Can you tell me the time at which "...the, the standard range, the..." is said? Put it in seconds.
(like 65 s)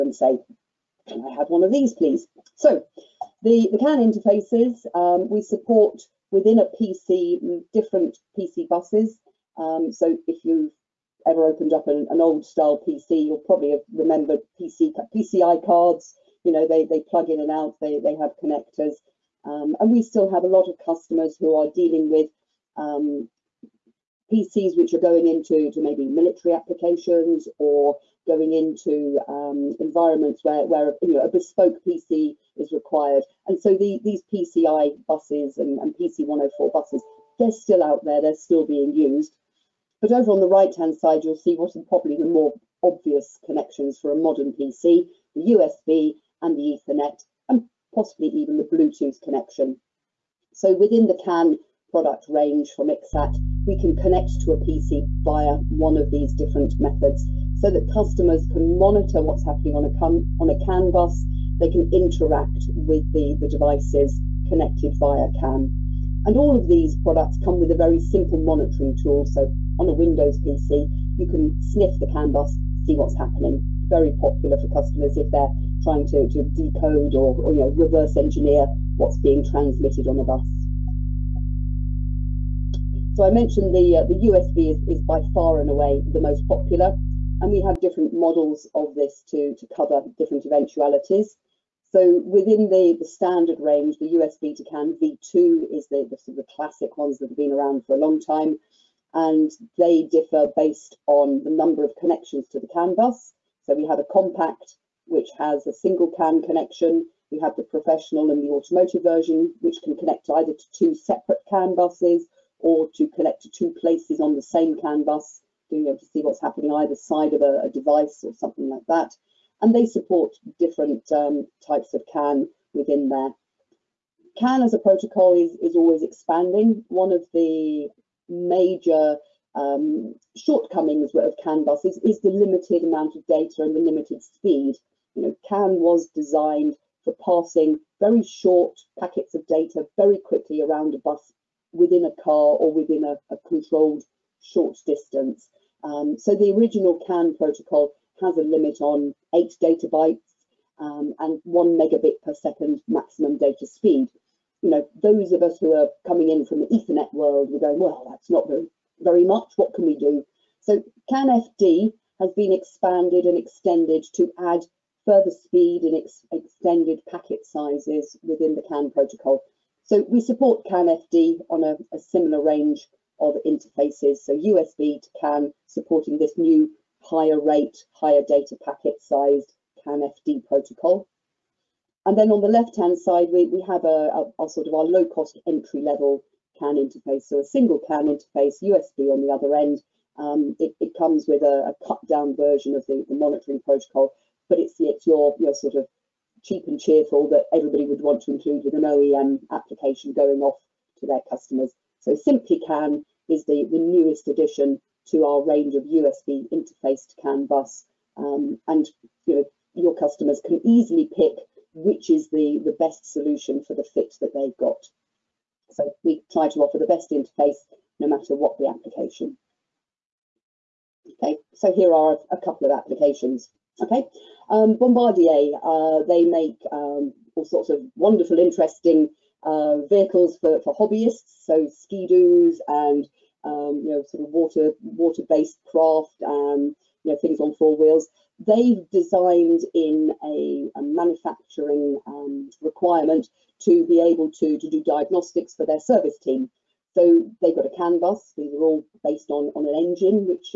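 92 s.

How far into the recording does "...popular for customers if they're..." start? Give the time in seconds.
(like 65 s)
74 s.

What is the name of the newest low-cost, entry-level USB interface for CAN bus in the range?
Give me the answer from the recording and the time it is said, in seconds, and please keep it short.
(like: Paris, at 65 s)
Simply CAN, at 202 s.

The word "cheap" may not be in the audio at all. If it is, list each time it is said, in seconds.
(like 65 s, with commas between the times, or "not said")
196 s.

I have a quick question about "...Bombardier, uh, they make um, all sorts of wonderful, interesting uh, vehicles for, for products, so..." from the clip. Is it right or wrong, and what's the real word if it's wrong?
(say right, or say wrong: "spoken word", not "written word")
wrong: "hobbyists", not "products".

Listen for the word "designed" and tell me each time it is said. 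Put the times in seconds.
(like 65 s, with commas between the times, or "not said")
136 s, 238 s.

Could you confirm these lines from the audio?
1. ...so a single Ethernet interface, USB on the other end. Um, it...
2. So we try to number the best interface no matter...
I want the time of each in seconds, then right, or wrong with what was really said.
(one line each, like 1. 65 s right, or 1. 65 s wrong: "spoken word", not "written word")
1. 187 s wrong: "CAN", not "Ethernet"
2. 215 s wrong: "offer", not "number".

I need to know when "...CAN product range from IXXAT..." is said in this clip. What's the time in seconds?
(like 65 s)
51 s.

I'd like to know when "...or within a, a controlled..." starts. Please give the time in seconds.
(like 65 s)
142 s.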